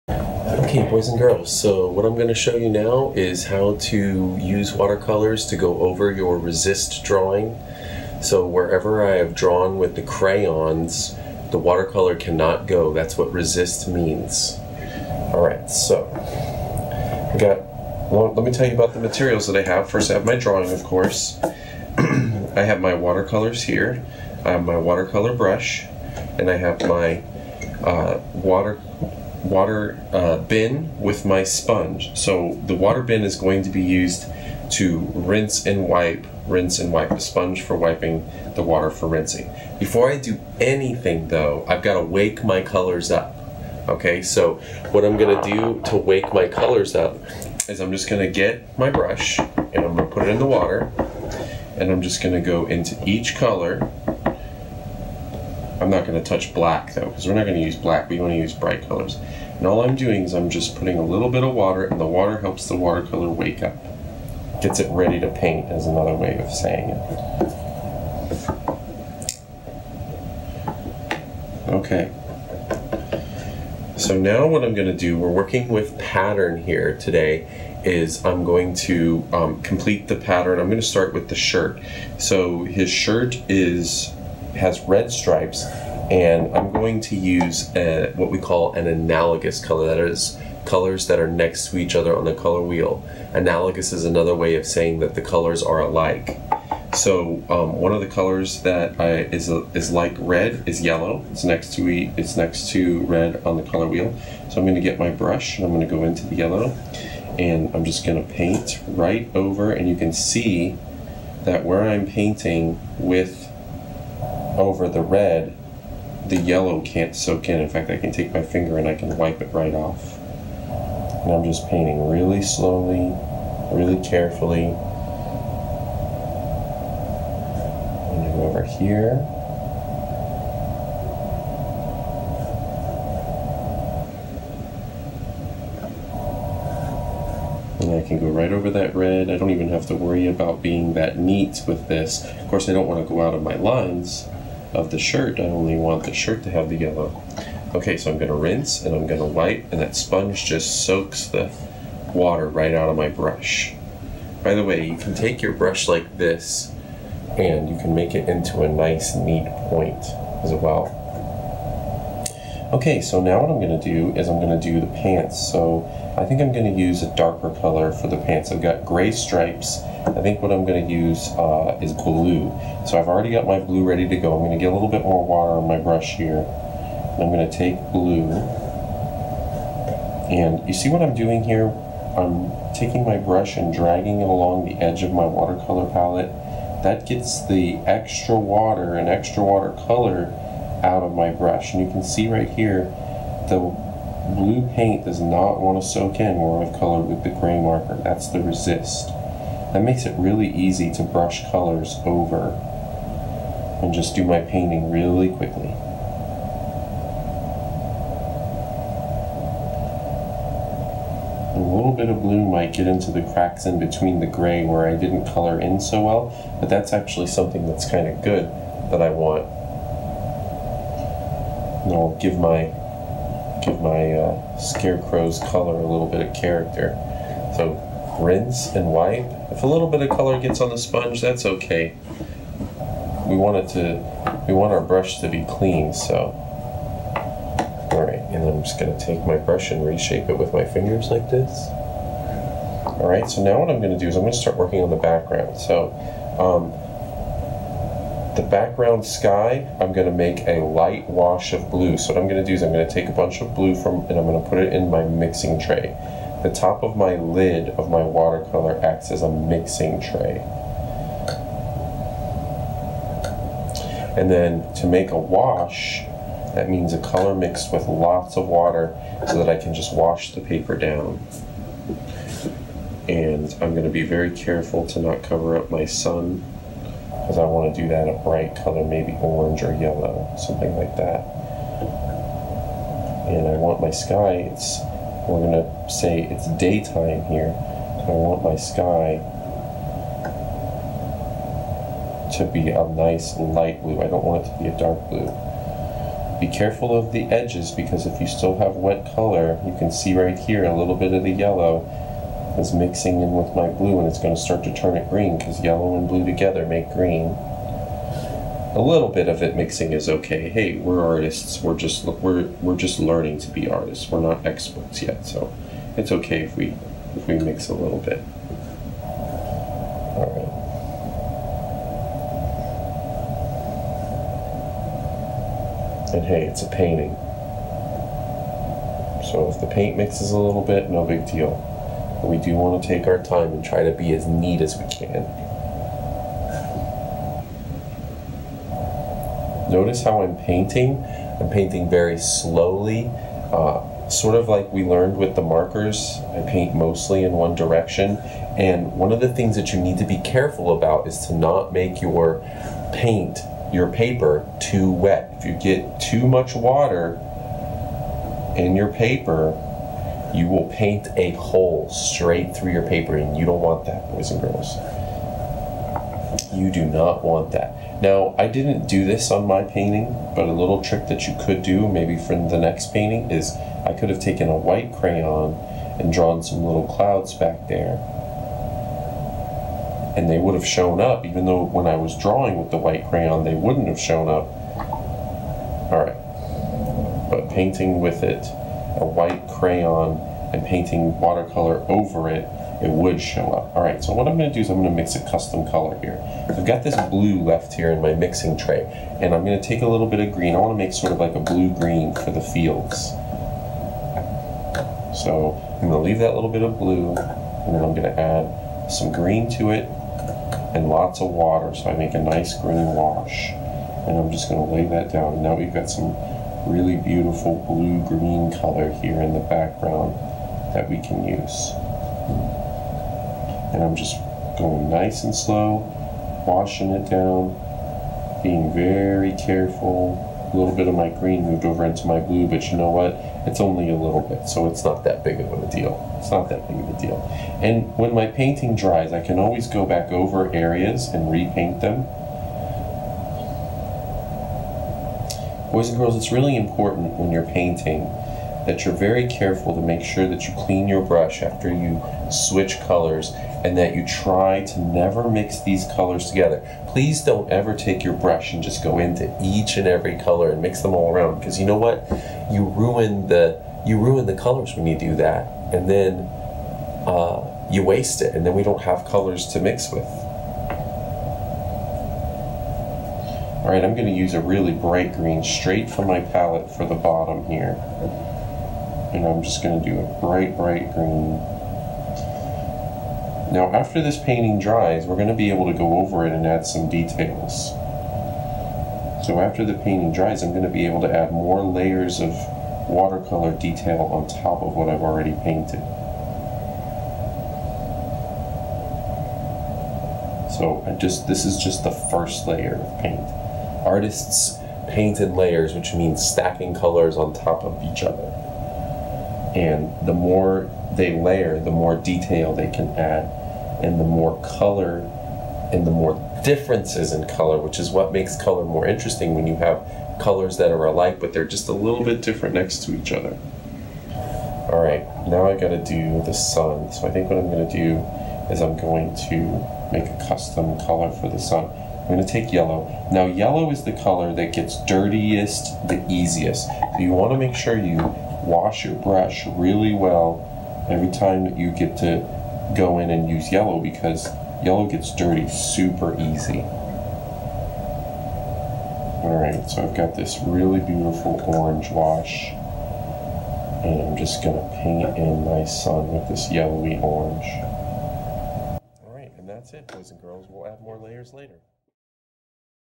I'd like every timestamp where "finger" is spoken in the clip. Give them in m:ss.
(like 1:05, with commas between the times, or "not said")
1:58, 4:00.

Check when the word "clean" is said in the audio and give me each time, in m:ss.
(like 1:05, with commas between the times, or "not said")
3:55, 7:30.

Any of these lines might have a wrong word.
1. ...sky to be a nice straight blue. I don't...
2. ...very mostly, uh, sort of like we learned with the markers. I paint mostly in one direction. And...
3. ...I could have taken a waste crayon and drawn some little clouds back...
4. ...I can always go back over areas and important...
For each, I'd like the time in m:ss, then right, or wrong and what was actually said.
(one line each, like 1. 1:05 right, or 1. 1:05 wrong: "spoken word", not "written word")
1. 4:48 wrong: "light", not "straight"
2. 5:41 wrong: "slowly", not "mostly"
3. 6:13 wrong: "white", not "waste"
4. 7:19 wrong: "repaint", not "important".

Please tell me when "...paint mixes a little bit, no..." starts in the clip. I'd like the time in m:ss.
5:29.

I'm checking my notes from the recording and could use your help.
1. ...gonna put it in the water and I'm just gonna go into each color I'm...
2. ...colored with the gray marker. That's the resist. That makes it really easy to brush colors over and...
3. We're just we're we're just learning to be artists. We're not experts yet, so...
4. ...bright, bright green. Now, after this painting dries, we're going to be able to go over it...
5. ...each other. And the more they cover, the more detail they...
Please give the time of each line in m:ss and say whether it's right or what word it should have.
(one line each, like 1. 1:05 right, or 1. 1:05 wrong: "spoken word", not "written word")
1. 0:49 right
2. 3:16 right
3. 5:11 right
4. 8:00 right
5. 8:27 wrong: "layer", not "cover".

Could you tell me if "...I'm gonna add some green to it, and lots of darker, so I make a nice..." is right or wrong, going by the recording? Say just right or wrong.
wrong.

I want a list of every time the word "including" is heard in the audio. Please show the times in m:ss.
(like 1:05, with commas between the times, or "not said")
not said.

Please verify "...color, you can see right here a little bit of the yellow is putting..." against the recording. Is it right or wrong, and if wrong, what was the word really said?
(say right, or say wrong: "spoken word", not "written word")
wrong: "mixing", not "putting".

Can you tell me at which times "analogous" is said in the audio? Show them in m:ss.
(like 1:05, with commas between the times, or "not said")
1:28, 1:33.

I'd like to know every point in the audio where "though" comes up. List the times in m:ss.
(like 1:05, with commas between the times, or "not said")
0:41, 0:56, 6:21.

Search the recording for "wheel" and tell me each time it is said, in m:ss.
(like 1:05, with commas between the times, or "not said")
1:32, 1:43.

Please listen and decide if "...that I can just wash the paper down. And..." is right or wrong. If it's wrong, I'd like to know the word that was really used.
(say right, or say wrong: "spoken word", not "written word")
right.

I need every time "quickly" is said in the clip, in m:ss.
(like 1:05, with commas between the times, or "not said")
3:25.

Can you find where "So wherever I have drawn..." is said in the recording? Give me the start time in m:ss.
0:08.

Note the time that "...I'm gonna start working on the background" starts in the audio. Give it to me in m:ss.
4:04.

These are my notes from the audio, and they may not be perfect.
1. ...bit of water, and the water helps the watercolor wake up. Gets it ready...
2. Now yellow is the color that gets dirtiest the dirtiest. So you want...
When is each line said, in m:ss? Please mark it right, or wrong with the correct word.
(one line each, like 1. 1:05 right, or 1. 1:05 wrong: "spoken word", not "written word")
1. 1:01 right
2. 8:53 wrong: "easiest", not "dirtiest".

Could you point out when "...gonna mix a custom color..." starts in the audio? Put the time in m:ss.
6:34.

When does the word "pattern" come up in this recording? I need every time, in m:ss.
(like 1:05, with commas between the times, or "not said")
1:15, 1:20.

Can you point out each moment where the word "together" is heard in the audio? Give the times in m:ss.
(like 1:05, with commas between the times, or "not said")
5:06, 7:36.